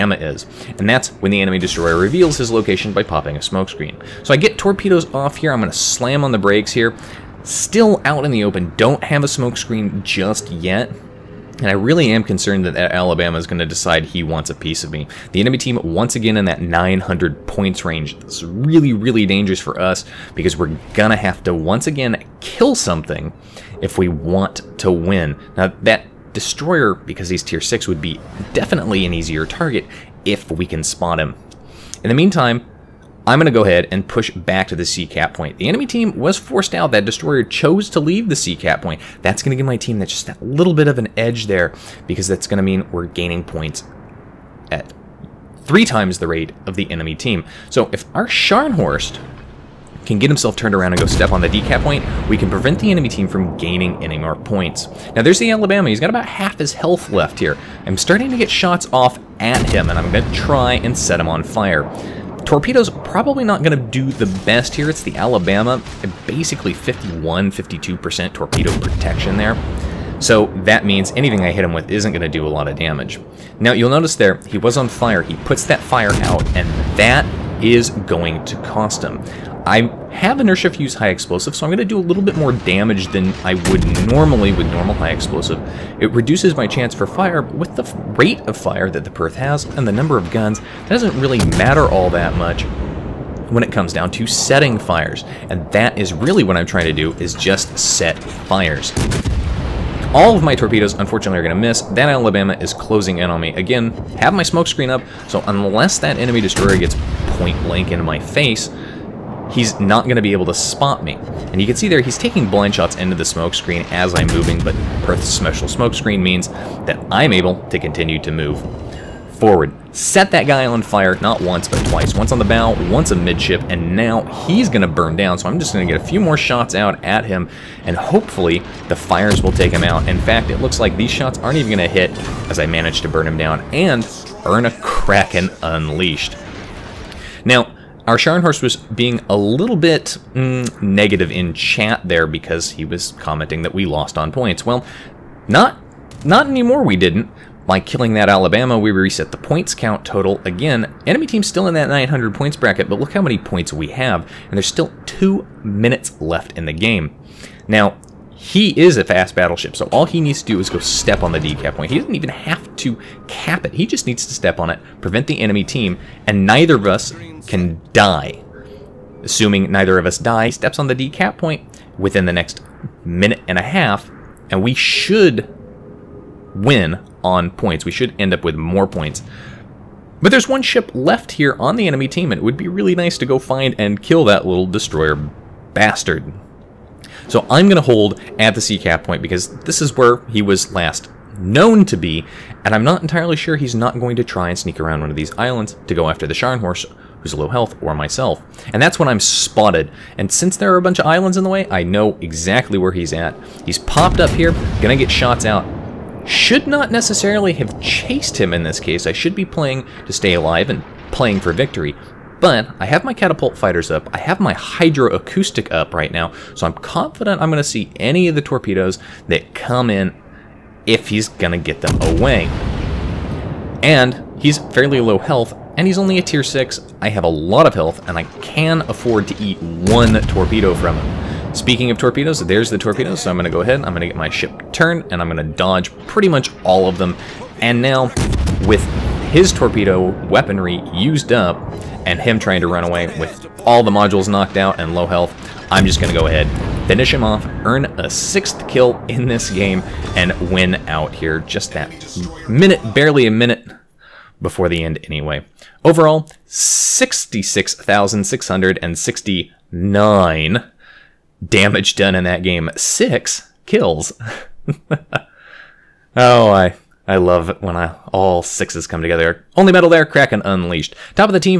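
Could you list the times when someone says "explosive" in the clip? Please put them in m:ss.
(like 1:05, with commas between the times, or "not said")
1:21, 1:25.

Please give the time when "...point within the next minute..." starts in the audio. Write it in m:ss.
2:51.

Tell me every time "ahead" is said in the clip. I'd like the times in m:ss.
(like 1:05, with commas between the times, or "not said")
0:33, 3:53, 4:06.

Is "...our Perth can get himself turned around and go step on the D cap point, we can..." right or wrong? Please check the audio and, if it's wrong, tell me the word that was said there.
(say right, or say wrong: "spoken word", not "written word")
wrong: "Scharnhorst", not "Perth".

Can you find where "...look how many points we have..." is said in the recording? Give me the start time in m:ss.
2:32.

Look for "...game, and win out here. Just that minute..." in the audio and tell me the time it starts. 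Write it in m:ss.
4:09.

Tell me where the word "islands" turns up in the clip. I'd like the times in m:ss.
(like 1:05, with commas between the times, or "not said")
3:15, 3:21.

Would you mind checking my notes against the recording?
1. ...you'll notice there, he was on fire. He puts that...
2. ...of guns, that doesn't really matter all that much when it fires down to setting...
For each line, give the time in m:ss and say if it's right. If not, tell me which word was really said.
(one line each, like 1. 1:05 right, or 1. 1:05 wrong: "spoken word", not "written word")
1. 1:13 right
2. 1:30 wrong: "comes", not "fires".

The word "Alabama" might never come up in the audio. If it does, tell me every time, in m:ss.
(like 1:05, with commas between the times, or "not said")
0:12, 0:55, 1:05, 1:42, 2:28.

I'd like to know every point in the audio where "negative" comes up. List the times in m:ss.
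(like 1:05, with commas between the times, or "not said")
2:20.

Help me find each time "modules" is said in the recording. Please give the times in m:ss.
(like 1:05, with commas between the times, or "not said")
4:03.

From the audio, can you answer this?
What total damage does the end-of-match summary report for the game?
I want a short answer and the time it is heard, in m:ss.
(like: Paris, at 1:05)
66,669, at 4:16.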